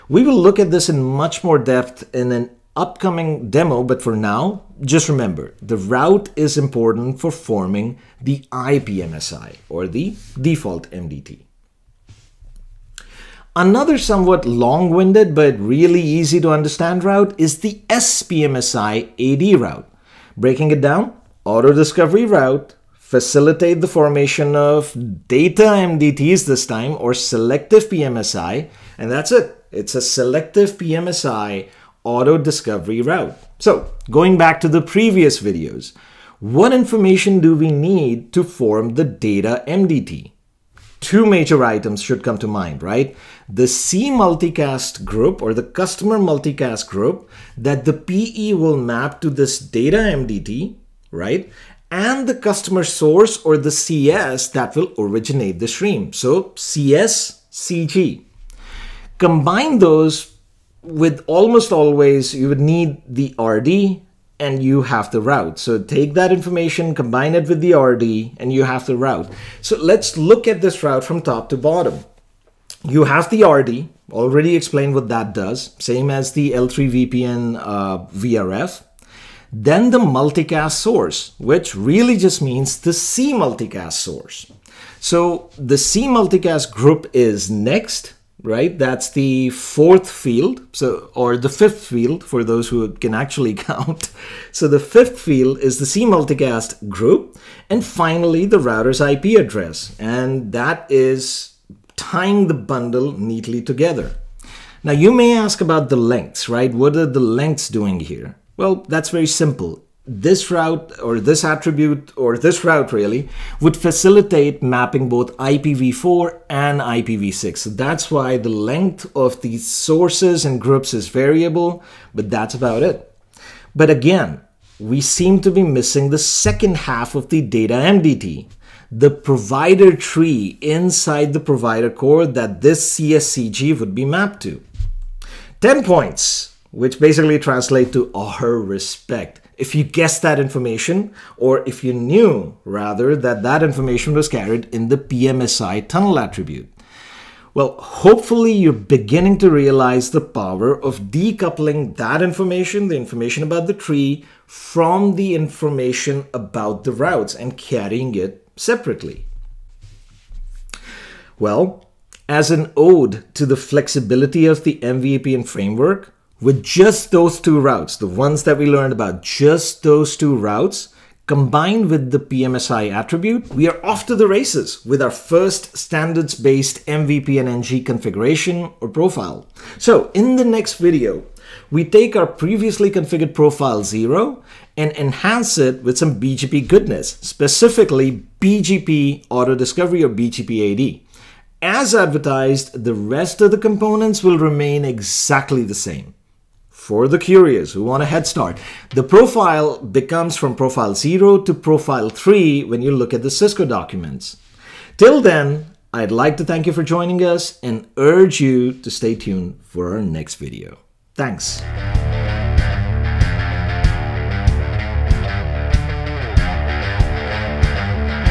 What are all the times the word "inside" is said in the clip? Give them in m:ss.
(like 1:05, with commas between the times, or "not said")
2:10.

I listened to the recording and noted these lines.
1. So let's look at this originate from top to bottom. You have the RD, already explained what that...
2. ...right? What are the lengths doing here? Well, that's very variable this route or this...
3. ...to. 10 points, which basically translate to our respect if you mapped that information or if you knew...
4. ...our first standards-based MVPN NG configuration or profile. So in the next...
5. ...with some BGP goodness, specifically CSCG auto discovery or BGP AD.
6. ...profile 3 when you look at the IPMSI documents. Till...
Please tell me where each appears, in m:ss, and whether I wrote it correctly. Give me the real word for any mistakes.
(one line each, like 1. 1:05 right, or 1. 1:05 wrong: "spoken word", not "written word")
1. 1:09 wrong: "route", not "originate"
2. 1:46 wrong: "simple", not "variable"
3. 2:14 wrong: "guessed", not "mapped"
4. 2:55 right
5. 3:05 wrong: "BGP", not "CSCG"
6. 3:21 wrong: "Cisco", not "IPMSI".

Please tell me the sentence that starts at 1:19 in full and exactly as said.
Then the multicast source, which really just means the C multicast source.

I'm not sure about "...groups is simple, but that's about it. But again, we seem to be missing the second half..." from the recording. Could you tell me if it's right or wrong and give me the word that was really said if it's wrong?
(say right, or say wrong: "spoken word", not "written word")
wrong: "variable", not "simple".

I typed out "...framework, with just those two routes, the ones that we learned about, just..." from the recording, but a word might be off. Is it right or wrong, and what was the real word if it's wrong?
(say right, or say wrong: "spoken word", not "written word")
right.